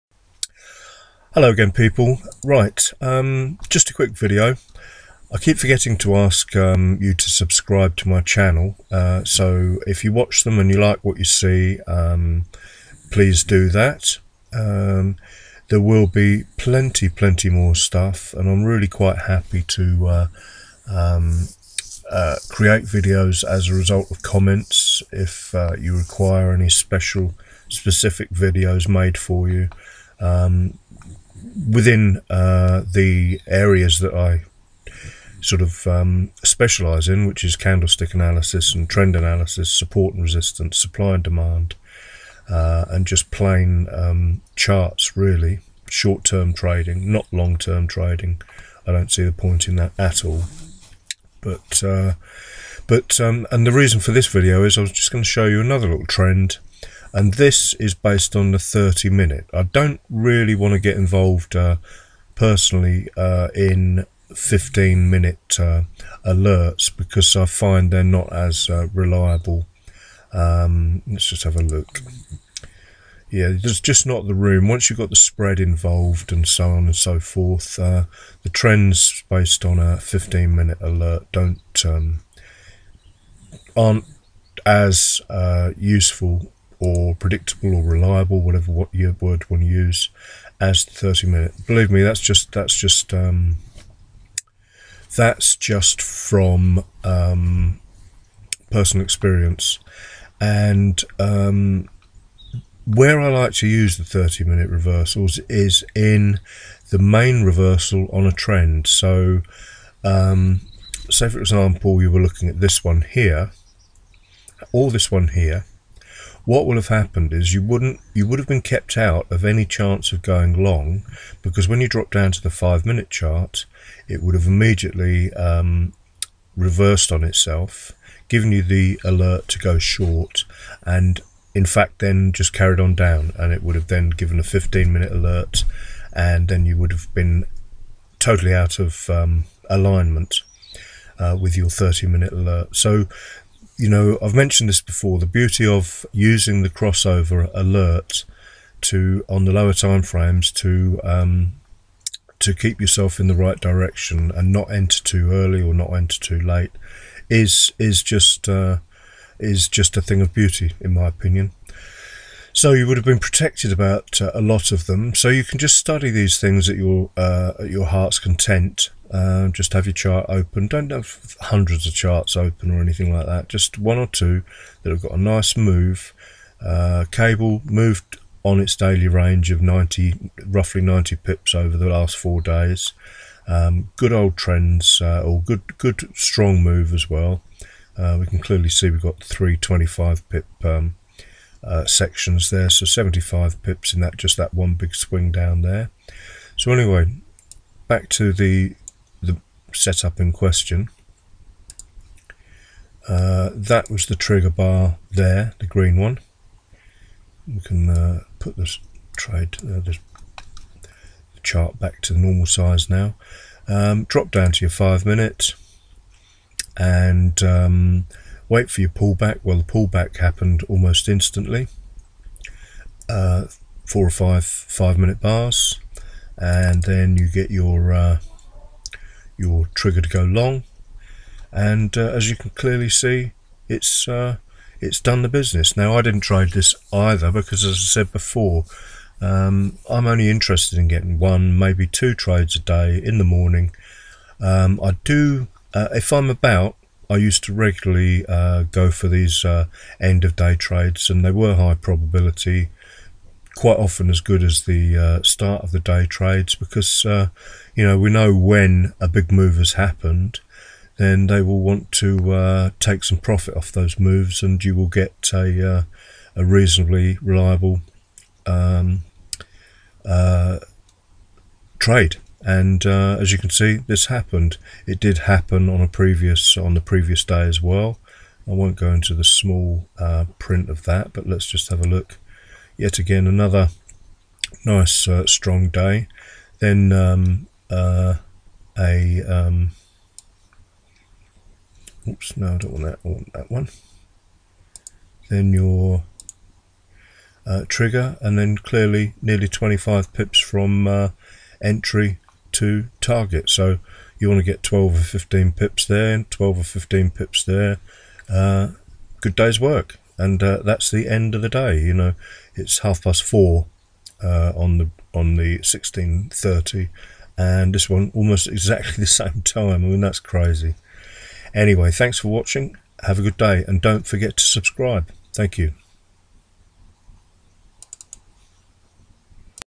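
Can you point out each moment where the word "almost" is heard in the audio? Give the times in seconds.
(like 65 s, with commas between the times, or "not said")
220 s, 318 s.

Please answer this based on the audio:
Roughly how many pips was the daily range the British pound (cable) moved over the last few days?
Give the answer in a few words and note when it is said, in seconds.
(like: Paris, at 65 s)
90, at 180 s.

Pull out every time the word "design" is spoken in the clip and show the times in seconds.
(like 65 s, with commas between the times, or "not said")
not said.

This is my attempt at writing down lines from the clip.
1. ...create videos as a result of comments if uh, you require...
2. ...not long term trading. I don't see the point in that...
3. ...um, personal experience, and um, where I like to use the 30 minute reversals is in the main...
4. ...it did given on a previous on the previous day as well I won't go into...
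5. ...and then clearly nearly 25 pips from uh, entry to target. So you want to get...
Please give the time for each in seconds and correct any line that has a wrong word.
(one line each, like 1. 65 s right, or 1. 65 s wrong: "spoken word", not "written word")
1. 22 s right
2. 47 s right
3. 97 s right
4. 274 s wrong: "happen", not "given"
5. 298 s right.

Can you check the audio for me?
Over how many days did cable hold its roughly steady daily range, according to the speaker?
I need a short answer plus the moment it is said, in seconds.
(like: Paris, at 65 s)
4, at 182 s.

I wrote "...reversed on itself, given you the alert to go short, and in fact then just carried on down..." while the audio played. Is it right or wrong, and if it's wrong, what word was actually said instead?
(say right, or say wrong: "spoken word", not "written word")
right.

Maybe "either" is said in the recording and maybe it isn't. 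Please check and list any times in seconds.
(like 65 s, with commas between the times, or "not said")
236 s.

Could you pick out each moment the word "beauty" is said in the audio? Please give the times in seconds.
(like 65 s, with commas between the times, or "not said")
145 s, 160 s.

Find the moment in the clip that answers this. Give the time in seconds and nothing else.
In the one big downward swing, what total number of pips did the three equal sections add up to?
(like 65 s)
192 s.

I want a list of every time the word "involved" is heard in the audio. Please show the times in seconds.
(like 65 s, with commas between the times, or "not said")
60 s, 75 s.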